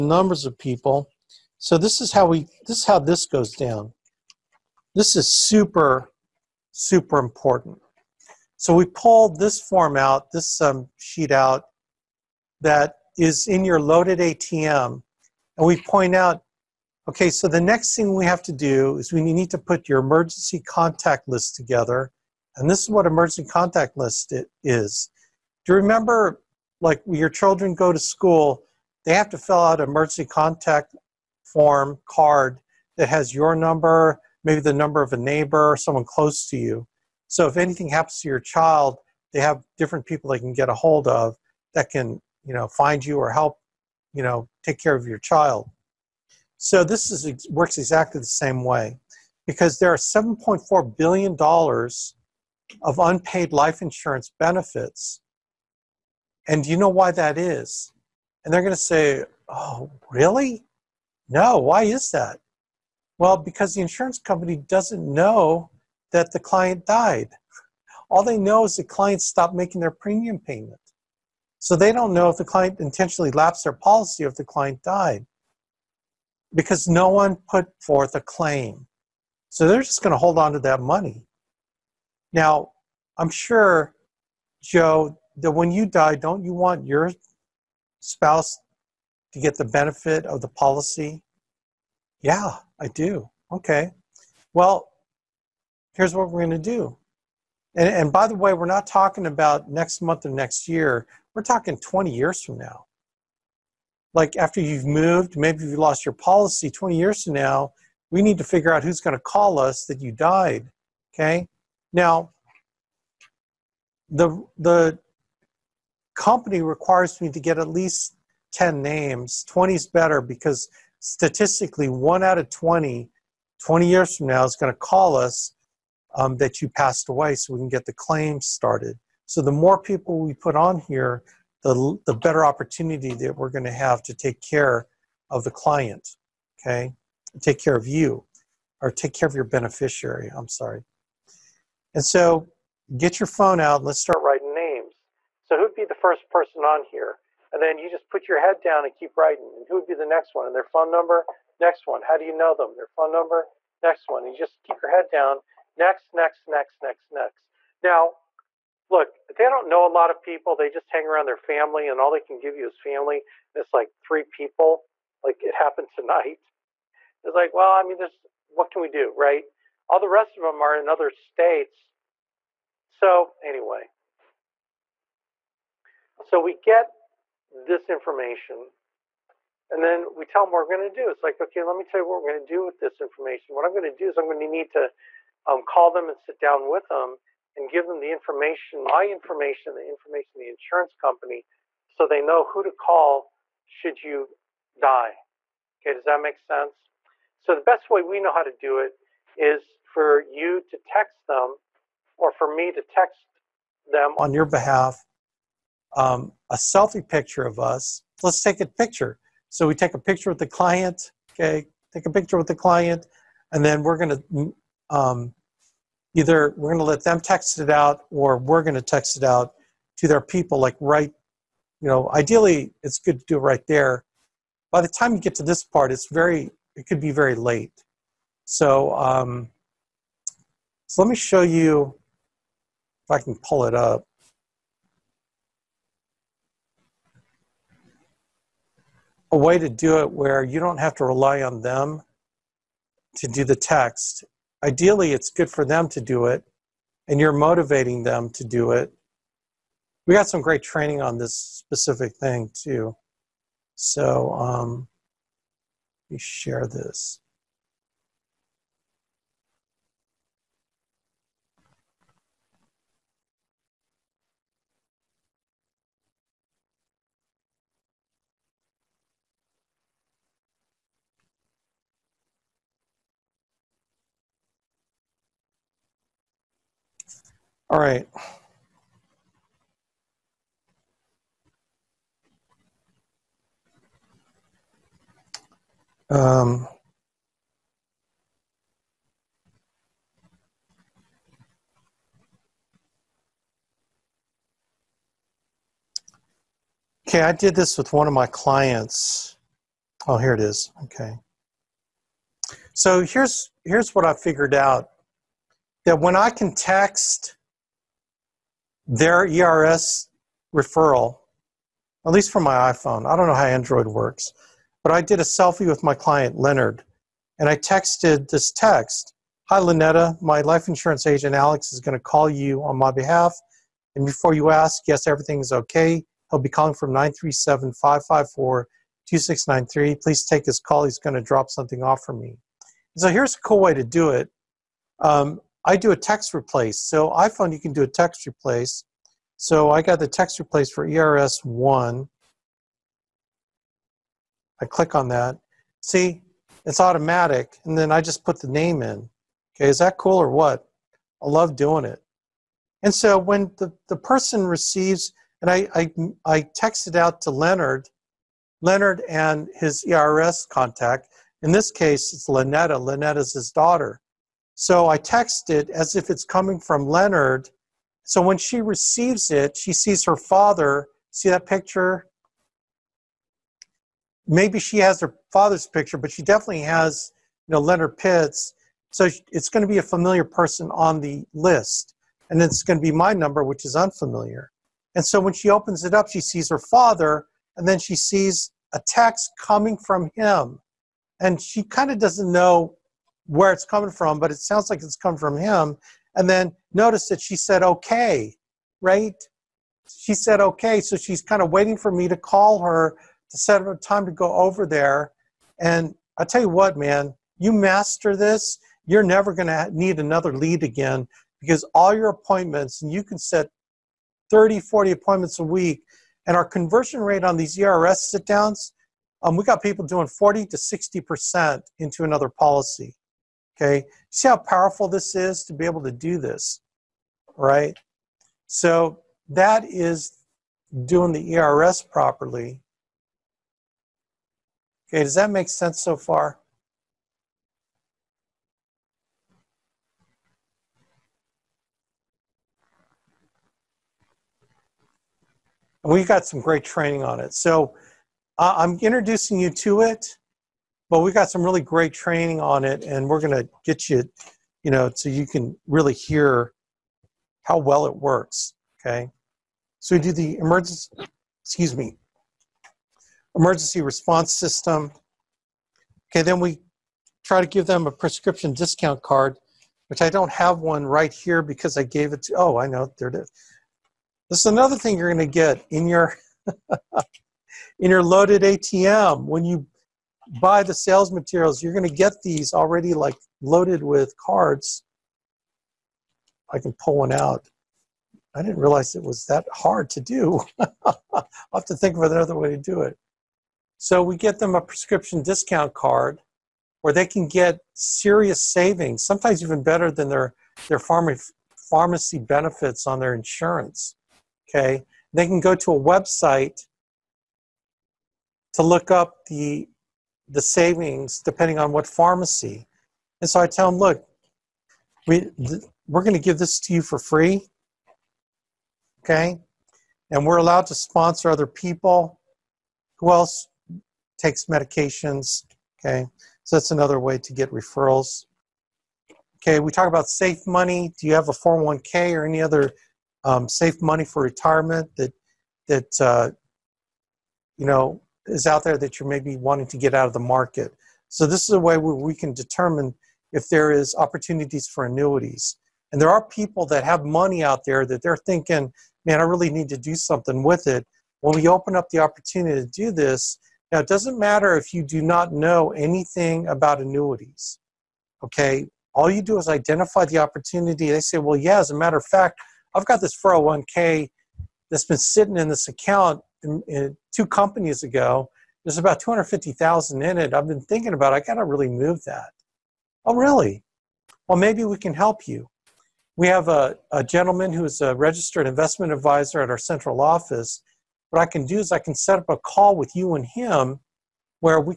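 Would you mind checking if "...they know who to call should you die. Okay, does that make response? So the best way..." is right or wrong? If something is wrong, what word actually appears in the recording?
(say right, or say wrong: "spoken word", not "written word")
wrong: "sense", not "response".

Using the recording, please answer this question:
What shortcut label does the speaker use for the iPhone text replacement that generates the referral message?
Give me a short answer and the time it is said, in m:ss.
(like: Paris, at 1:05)
ERS1, at 5:40.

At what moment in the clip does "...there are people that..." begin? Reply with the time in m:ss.
9:05.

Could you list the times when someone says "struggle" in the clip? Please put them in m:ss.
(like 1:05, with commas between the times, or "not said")
not said.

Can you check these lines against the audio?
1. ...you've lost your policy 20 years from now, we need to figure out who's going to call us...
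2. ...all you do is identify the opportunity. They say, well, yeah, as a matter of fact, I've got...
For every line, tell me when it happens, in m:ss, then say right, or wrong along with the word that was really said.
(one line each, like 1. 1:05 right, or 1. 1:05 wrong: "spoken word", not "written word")
1. 1:45 right
2. 9:18 right.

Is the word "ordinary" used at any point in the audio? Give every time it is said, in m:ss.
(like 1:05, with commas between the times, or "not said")
not said.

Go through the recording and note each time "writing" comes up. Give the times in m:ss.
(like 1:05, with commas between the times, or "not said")
2:24, 2:29.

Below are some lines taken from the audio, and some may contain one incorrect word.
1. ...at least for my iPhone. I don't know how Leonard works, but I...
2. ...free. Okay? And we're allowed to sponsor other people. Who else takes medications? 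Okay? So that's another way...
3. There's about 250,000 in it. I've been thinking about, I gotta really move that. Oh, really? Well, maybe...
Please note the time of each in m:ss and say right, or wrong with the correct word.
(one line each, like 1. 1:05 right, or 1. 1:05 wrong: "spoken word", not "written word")
1. 5:12 wrong: "Android", not "Leonard"
2. 8:36 right
3. 9:28 right.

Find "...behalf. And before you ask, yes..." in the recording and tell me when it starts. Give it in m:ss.
5:22.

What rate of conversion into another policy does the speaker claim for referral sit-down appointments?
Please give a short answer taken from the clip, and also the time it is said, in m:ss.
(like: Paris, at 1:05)
40 to 60%, at 7:00.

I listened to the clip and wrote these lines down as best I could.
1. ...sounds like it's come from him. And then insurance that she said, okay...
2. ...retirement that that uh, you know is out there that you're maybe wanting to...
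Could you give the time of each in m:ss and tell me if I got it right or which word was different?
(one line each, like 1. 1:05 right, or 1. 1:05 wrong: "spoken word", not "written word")
1. 6:34 wrong: "notice", not "insurance"
2. 8:54 right.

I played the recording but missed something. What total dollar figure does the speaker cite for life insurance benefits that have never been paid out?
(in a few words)
$7.4 billion.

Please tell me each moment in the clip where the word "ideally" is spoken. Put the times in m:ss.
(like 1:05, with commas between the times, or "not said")
3:42, 4:04.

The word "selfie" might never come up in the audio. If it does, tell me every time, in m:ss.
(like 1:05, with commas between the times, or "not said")
3:26, 5:15.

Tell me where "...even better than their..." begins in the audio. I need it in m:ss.
8:19.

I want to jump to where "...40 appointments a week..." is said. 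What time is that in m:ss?
6:54.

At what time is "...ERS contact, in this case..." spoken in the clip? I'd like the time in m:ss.
5:59.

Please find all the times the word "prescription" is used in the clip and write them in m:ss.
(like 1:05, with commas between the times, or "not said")
7:47, 8:14.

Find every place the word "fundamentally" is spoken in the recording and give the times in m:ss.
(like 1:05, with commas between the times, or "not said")
not said.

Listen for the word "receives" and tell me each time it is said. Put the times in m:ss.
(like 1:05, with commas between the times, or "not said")
5:54, 6:08.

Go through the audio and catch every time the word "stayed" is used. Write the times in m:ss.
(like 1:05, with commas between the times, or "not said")
not said.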